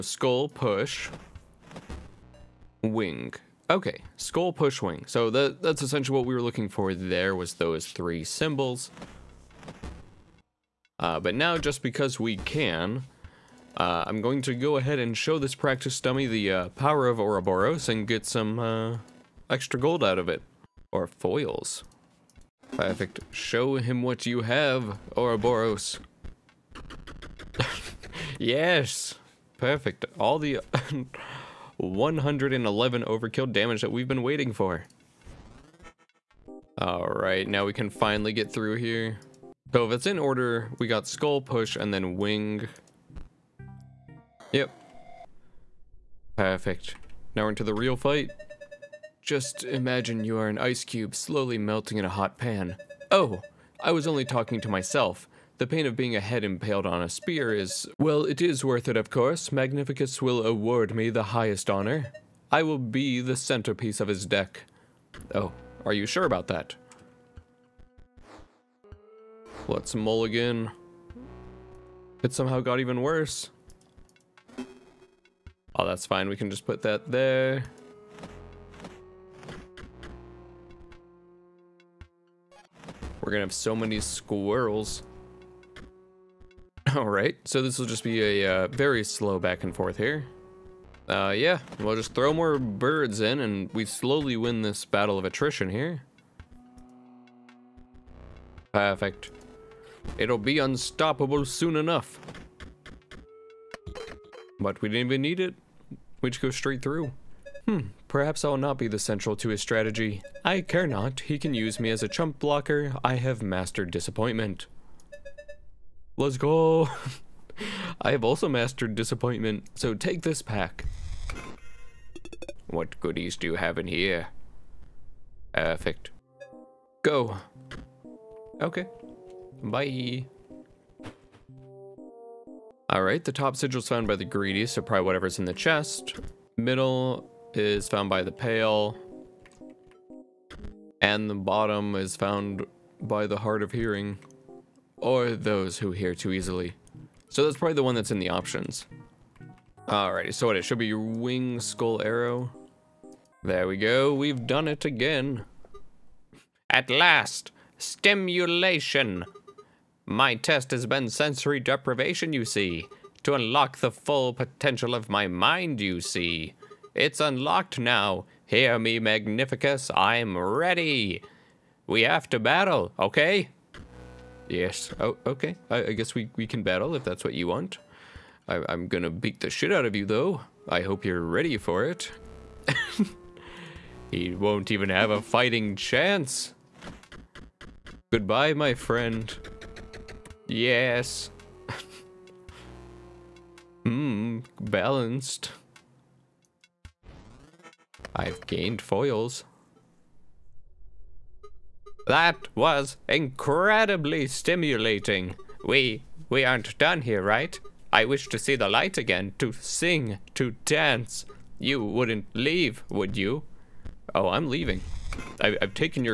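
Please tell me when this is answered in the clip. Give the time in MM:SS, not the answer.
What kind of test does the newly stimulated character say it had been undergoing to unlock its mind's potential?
02:41.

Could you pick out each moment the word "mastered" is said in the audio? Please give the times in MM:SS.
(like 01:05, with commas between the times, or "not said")
01:53, 01:58.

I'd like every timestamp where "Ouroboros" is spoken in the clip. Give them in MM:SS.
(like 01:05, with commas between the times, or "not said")
00:17, 00:25.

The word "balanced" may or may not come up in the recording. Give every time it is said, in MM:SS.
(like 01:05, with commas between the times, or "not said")
03:14.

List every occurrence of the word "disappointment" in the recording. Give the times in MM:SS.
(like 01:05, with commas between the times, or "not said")
01:53, 01:58.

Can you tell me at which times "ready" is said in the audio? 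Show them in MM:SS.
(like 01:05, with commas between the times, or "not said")
02:50, 03:01.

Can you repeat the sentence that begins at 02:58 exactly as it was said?
I, I'm gonna beat the shit out of you, though.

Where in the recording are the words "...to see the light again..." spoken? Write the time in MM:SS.
03:28.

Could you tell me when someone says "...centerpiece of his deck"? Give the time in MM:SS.
01:03.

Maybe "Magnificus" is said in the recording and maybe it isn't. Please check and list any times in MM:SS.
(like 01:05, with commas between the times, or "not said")
00:59, 02:48.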